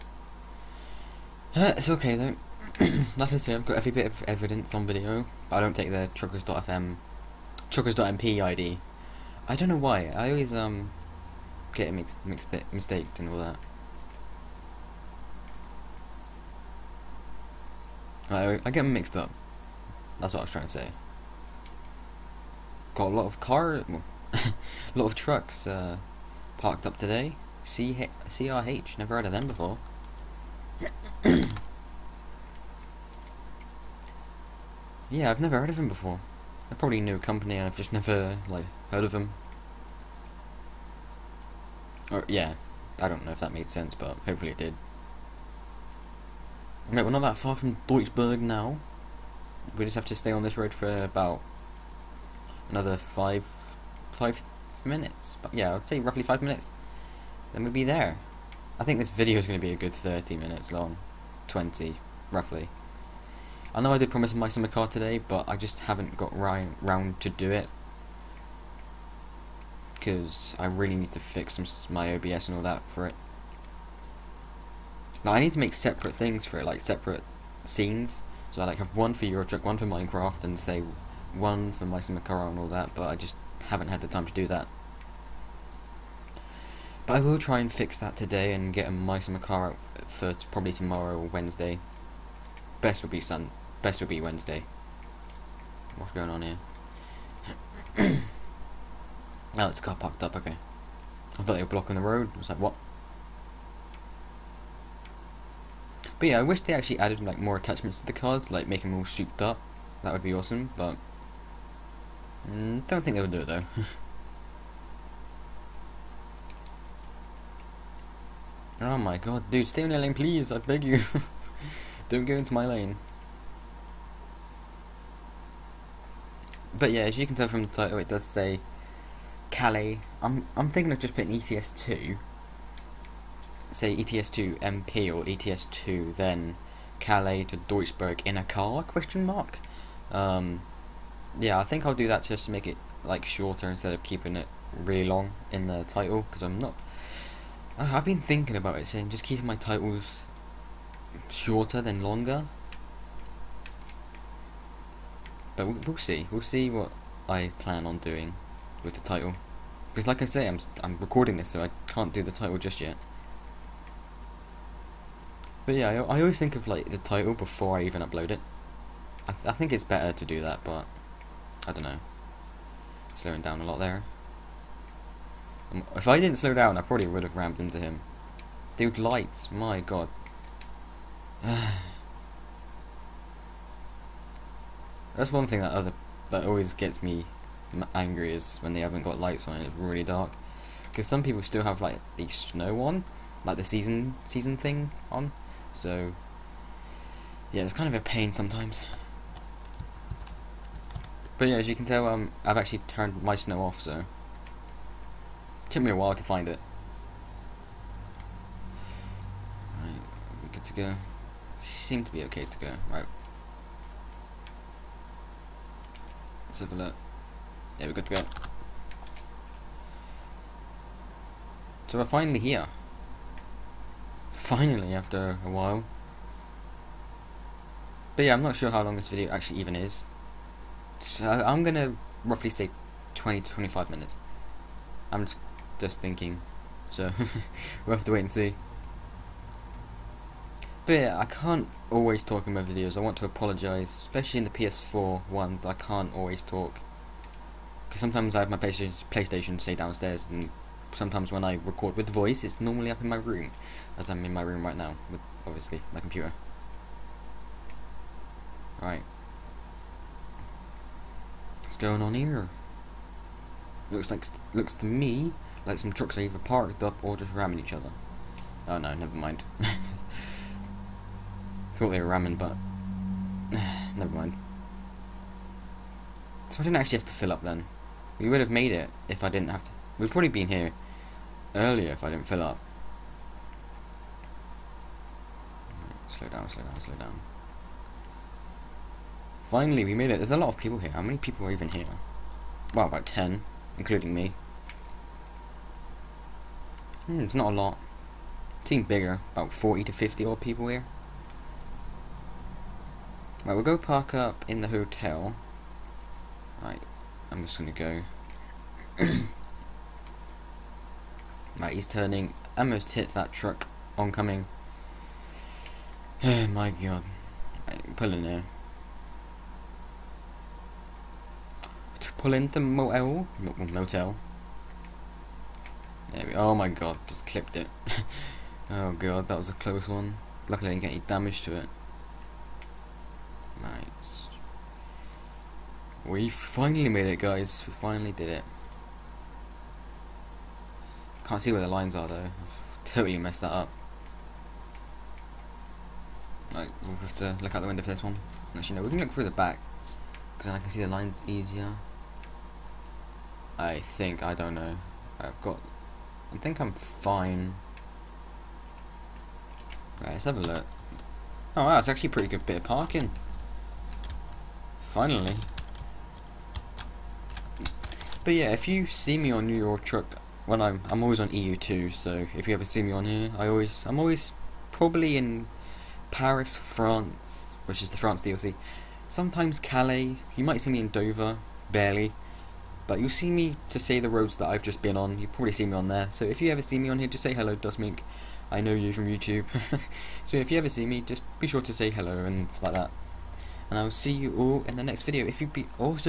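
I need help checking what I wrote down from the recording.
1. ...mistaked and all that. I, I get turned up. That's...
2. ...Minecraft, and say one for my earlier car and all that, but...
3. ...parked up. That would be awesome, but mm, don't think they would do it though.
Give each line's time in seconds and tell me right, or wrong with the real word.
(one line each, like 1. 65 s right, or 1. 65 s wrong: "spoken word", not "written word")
1. 12 s wrong: "mixed", not "turned"
2. 79 s wrong: "summer", not "earlier"
3. 109 s wrong: "souped", not "parked".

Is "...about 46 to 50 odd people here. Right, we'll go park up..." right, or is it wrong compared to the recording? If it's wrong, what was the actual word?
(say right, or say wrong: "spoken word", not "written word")
wrong: "40", not "46".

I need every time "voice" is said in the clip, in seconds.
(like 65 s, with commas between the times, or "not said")
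252 s.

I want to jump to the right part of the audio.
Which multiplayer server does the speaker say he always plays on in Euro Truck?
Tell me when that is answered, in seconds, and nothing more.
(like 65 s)
371 s.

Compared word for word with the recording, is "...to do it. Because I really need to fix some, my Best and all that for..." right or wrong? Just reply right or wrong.
wrong.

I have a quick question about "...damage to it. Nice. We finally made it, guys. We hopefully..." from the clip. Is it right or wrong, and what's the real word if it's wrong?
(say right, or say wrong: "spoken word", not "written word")
wrong: "finally", not "hopefully".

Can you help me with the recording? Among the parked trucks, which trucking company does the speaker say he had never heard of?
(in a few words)
CRH.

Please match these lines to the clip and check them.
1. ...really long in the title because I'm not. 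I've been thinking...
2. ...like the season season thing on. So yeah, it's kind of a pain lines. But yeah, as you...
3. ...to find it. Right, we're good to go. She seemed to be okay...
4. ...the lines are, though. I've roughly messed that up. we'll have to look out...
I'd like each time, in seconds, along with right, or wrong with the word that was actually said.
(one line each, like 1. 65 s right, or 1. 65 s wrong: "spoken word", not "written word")
1. 144 s right
2. 193 s wrong: "sometimes", not "lines"
3. 206 s right
4. 341 s wrong: "totally", not "roughly".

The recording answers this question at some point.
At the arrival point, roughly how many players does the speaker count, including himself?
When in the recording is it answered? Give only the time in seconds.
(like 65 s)
292 s.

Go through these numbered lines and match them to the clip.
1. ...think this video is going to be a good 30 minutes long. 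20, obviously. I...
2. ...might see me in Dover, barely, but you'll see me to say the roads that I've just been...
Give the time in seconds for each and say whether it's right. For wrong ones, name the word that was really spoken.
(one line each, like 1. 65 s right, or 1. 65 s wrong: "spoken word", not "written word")
1. 58 s wrong: "roughly", not "obviously"
2. 380 s right.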